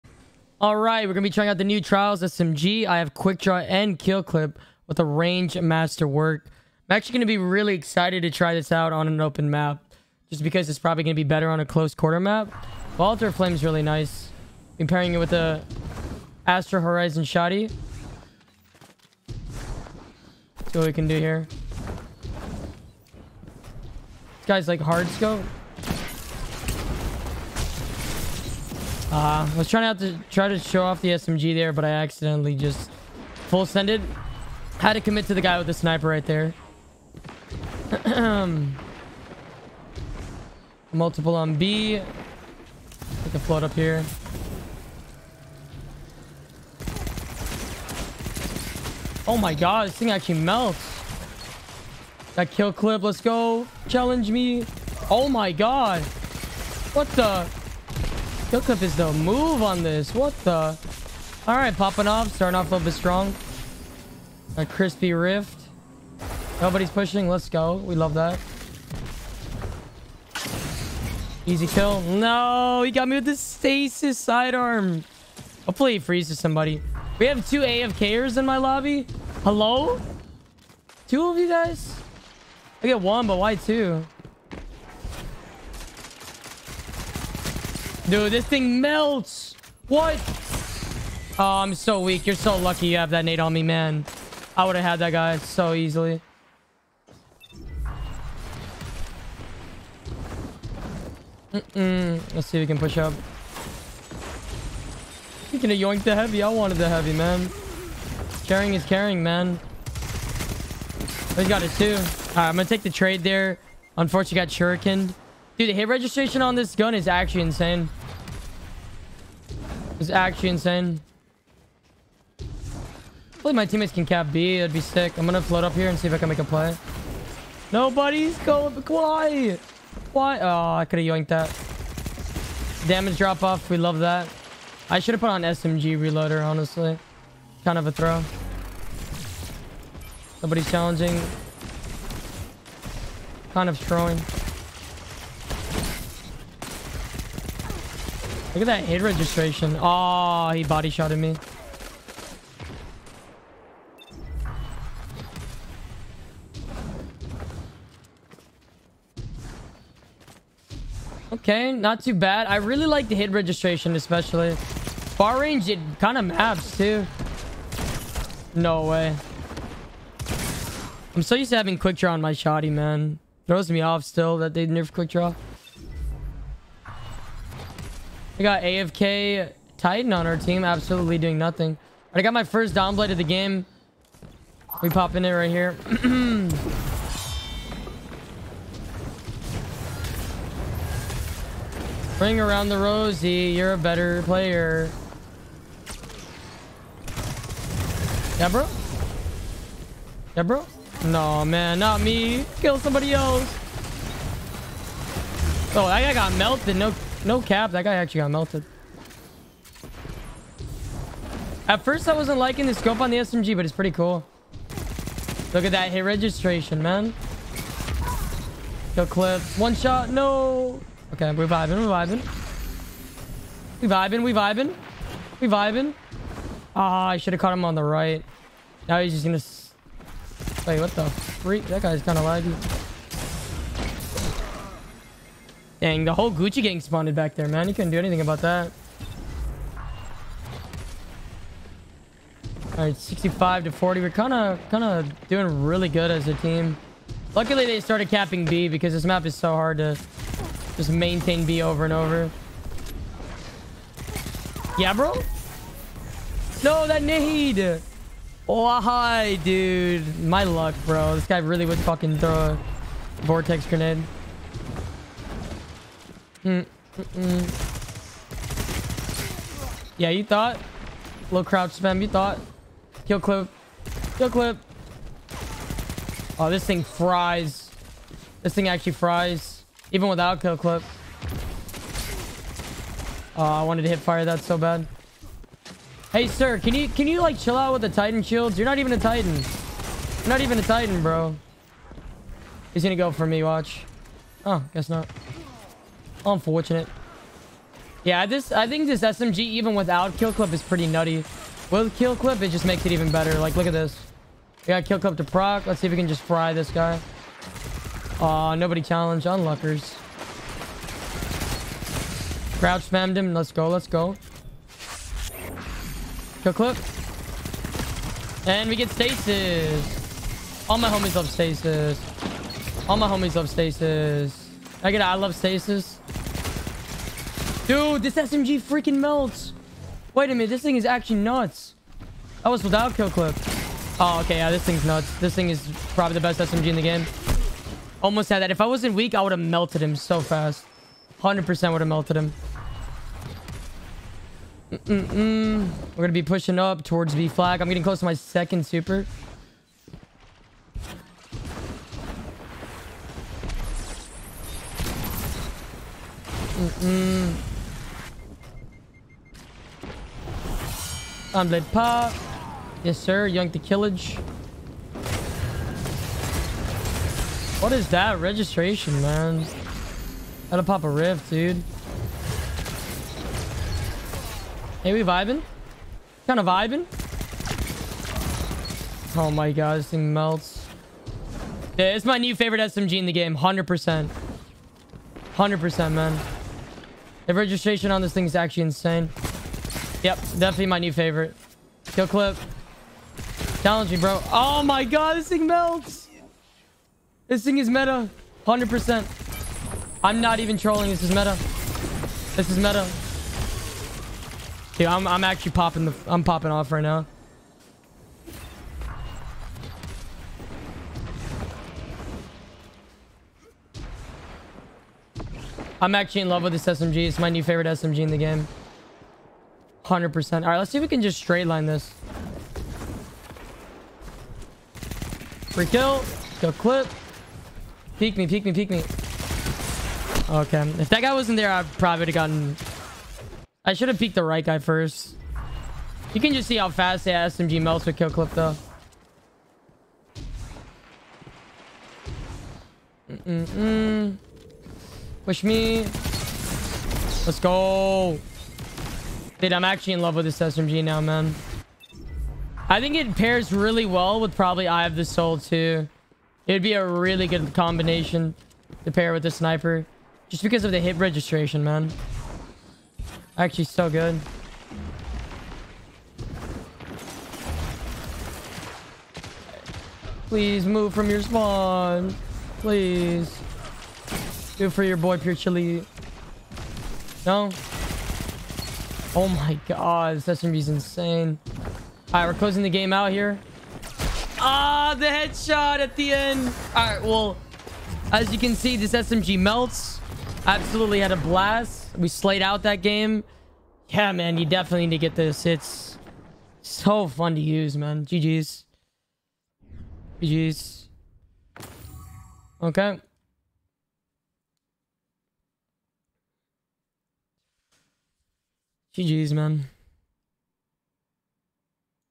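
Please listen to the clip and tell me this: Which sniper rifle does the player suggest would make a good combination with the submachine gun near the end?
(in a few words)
Eye of the Soul.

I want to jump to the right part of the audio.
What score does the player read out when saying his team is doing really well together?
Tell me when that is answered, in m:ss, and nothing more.
4:02.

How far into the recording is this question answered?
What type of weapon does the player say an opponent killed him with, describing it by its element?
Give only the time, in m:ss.
1:13.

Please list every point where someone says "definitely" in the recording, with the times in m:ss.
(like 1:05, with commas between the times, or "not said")
6:30, 8:14.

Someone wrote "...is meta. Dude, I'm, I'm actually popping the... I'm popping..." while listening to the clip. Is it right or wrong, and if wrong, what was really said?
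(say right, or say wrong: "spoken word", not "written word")
right.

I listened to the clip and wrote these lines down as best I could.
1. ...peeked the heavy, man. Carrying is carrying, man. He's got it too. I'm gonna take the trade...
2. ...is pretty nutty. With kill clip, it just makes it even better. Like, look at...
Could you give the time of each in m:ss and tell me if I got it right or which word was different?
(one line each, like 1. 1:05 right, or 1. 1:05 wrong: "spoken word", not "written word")
1. 1:46 wrong: "wanted", not "peeked"
2. 5:00 right.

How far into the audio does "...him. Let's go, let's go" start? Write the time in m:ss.
5:13.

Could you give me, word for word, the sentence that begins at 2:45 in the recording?
Far range, it kind of maps, too.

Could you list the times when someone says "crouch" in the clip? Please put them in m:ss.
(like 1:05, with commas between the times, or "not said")
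4:31, 5:12.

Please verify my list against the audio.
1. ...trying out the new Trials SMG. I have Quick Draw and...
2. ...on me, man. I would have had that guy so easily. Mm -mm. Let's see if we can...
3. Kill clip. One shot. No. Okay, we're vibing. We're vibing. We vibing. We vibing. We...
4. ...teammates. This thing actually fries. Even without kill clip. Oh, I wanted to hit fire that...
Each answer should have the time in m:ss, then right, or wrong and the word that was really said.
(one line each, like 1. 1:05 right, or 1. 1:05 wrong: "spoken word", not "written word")
1. 0:01 right
2. 1:33 right
3. 3:38 right
4. 4:36 wrong: "fries", not "teammates".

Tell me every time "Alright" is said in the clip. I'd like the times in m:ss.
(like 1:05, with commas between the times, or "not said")
8:02, 8:06.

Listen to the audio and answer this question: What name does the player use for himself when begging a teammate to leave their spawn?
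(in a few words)
Pure Chili.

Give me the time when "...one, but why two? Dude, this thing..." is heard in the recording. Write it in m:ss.
1:22.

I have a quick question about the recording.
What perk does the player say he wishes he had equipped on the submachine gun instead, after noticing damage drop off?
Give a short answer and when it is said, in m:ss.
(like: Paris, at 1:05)
SMG reloader, at 2:15.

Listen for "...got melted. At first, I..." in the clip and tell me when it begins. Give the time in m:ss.
3:28.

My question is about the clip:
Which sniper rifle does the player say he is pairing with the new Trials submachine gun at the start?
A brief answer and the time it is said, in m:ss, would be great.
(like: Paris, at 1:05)
Astral Horizon, at 0:16.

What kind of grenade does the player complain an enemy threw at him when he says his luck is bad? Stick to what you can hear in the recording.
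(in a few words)
vortex grenade.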